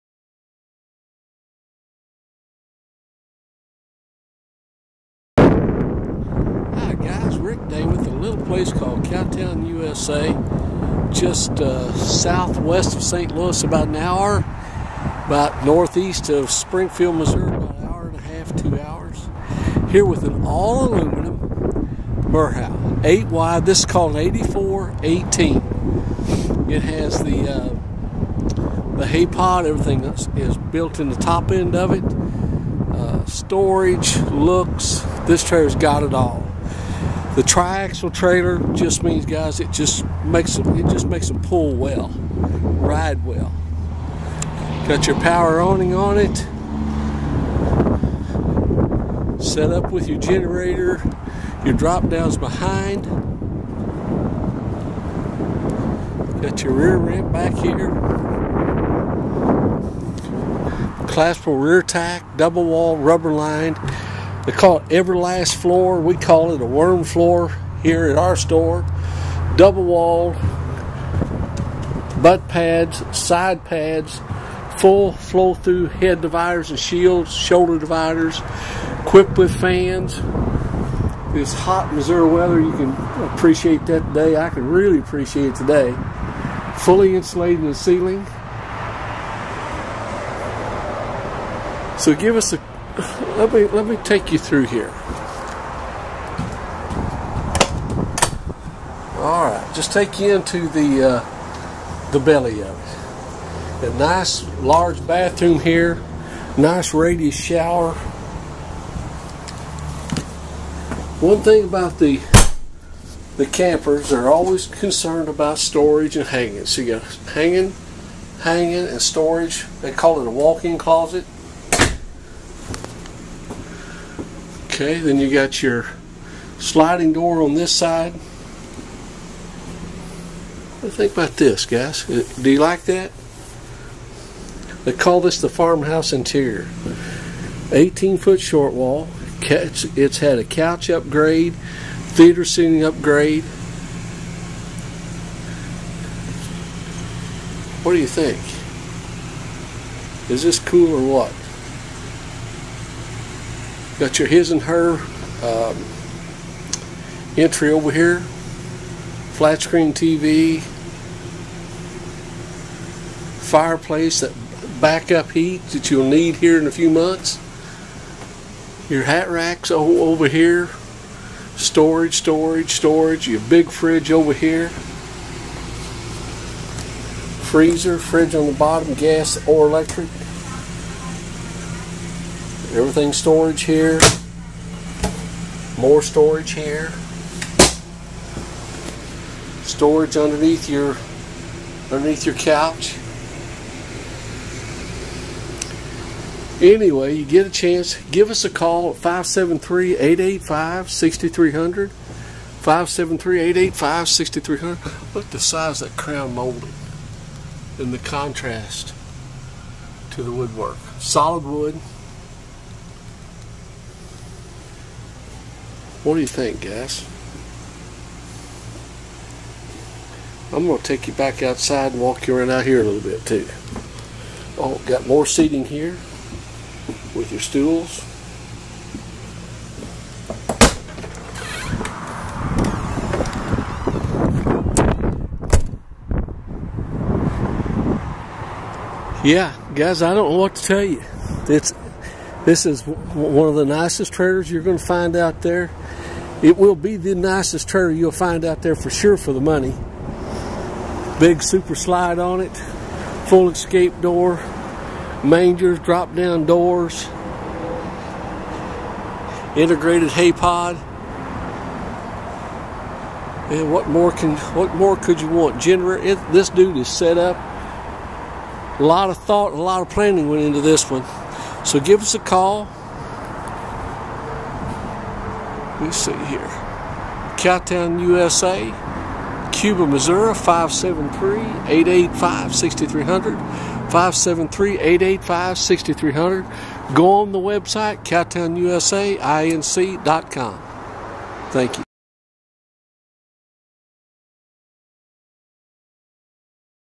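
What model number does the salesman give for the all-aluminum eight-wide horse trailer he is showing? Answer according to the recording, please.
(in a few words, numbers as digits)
8418.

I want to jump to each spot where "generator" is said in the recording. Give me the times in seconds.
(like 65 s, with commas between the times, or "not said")
50 s, 265 s.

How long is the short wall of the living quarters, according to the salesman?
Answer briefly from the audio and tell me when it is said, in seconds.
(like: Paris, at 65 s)
18 foot, at 137 s.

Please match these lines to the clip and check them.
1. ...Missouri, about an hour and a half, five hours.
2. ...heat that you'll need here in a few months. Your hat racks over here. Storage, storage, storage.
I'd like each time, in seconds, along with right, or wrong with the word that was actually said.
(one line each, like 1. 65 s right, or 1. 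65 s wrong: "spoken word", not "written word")
1. 17 s wrong: "two", not "five"
2. 165 s right.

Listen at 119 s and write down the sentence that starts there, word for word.
They call it a walk-in closet.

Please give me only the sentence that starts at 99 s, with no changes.
All right, just take you into the uh, the belly of it.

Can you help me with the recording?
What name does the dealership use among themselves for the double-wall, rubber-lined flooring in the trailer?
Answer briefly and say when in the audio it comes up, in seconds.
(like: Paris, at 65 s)
worm floor, at 66 s.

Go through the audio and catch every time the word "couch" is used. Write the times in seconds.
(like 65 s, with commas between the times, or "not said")
140 s, 192 s.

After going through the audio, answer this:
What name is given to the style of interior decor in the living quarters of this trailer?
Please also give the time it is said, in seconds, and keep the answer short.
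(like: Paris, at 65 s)
farmhouse interior, at 135 s.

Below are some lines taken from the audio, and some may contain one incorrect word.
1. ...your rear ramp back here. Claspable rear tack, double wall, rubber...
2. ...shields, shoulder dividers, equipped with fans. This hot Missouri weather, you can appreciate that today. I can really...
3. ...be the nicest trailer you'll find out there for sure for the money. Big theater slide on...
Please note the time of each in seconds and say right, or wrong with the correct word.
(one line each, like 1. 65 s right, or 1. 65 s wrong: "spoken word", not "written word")
1. 56 s right
2. 76 s right
3. 246 s wrong: "super", not "theater".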